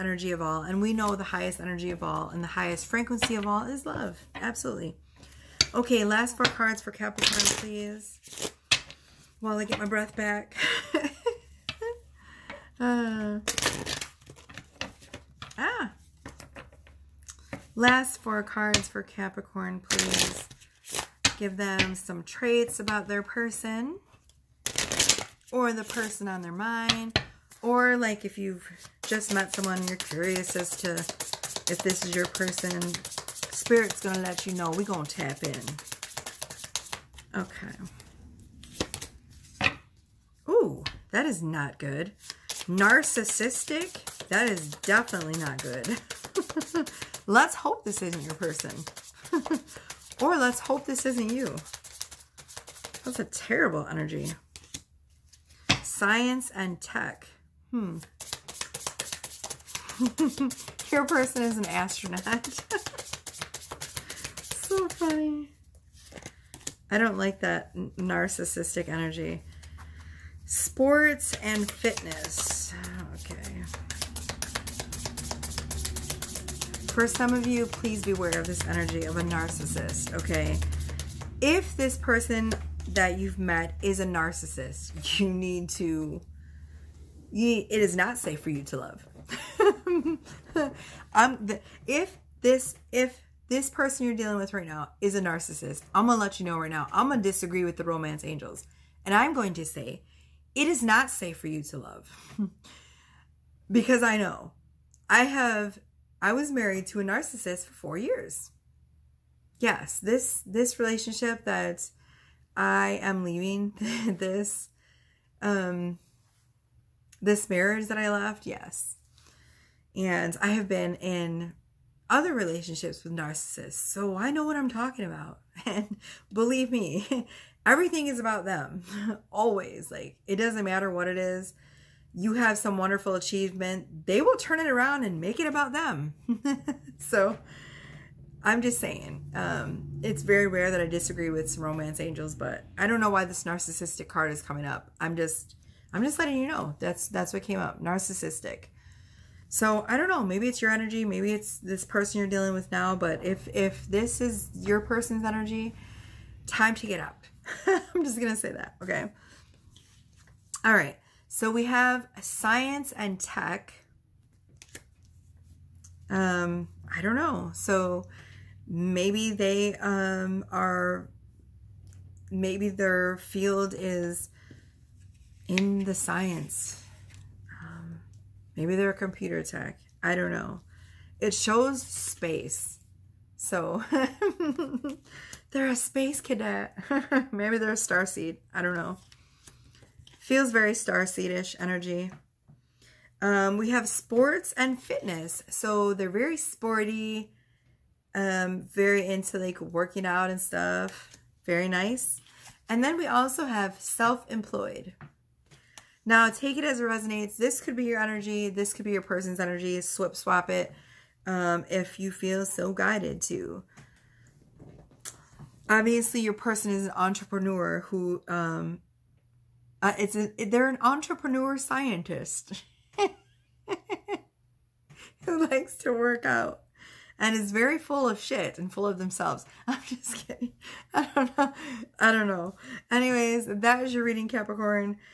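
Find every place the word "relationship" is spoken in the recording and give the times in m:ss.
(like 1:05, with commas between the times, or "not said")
1:50, 2:02.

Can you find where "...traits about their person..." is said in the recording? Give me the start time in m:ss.
0:22.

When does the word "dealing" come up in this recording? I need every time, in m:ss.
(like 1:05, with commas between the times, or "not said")
1:34, 2:32.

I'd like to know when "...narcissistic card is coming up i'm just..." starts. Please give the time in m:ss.
2:23.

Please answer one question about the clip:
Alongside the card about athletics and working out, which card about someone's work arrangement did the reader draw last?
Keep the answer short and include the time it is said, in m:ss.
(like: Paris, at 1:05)
Self-employed, at 3:23.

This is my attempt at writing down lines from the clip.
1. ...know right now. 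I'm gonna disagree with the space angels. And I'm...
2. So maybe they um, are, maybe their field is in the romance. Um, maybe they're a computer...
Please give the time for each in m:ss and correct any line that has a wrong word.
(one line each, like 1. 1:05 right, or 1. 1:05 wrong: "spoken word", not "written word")
1. 1:36 wrong: "romance", not "space"
2. 2:47 wrong: "science", not "romance".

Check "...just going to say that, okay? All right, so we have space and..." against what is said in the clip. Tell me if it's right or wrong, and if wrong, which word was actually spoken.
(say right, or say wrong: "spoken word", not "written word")
wrong: "science", not "space".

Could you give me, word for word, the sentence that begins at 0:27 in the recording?
Or like if you've just met someone, you're curious as to if this is your person.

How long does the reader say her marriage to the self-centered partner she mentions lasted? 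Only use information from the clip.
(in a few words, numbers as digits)
4 years.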